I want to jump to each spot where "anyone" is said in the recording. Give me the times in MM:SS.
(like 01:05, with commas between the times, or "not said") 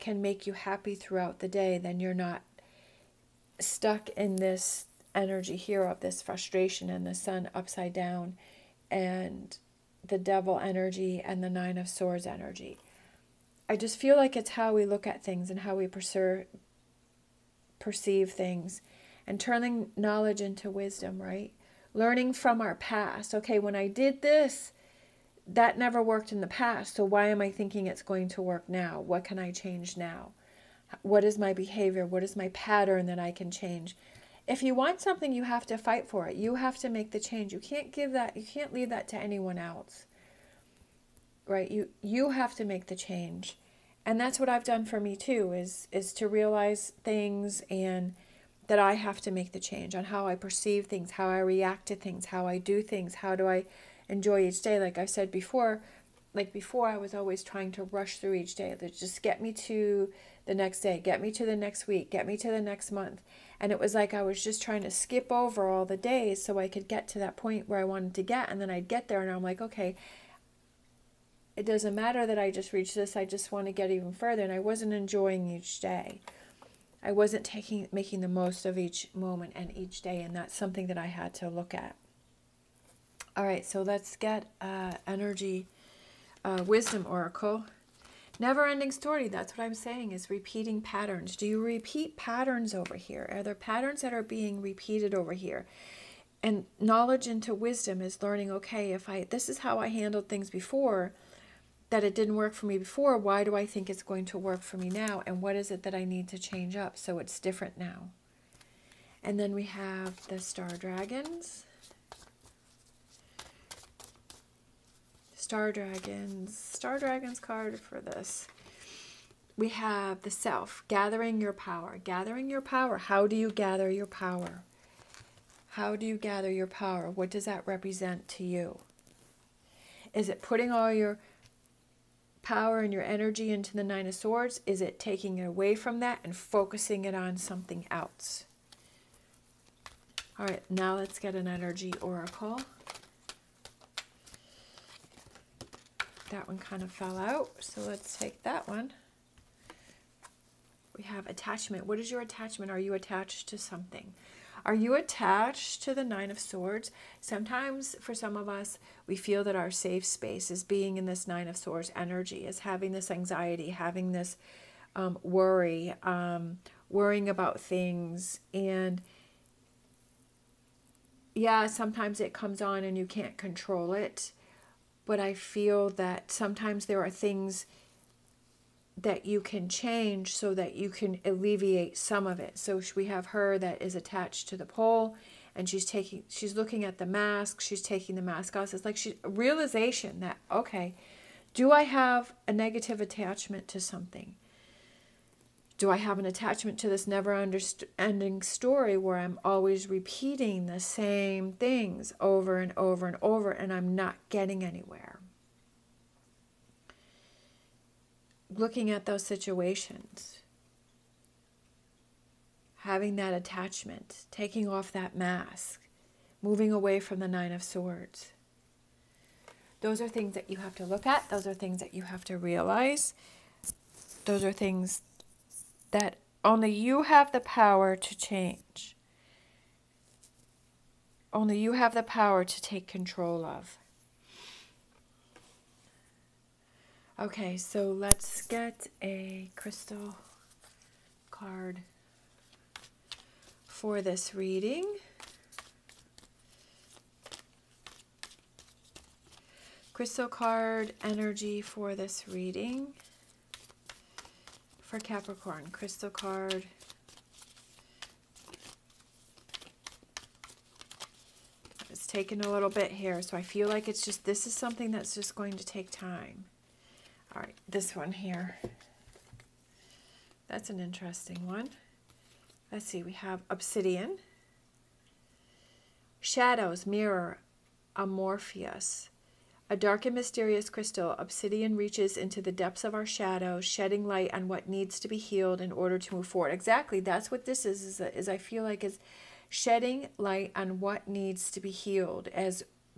00:39.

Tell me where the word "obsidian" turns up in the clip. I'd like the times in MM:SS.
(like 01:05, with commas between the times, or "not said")
04:33, 04:41.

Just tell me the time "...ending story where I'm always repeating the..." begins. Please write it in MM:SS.
03:17.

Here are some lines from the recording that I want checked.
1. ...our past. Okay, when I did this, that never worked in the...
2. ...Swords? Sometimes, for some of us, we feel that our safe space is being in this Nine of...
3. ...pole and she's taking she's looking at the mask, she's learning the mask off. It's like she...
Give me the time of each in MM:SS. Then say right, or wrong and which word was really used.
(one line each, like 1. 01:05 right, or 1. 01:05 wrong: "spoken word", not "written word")
1. 00:22 right
2. 02:36 right
3. 03:04 wrong: "taking", not "learning".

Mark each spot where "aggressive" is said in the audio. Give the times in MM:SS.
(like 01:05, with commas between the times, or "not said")
not said.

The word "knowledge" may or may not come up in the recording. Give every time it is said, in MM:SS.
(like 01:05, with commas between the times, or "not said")
00:19, 01:36.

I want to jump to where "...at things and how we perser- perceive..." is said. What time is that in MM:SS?
00:15.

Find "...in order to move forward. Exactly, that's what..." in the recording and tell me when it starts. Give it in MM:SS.
04:45.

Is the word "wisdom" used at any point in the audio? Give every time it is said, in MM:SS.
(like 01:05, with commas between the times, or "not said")
00:20, 01:26, 01:37.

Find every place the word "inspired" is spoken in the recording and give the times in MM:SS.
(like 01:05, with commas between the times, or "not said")
not said.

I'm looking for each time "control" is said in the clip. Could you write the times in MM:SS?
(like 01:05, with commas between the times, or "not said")
02:53, 03:52.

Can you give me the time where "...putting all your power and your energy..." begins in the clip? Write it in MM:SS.
02:10.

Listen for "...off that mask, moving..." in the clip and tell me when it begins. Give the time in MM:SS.
03:34.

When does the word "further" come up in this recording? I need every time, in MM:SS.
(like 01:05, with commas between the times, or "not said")
01:14.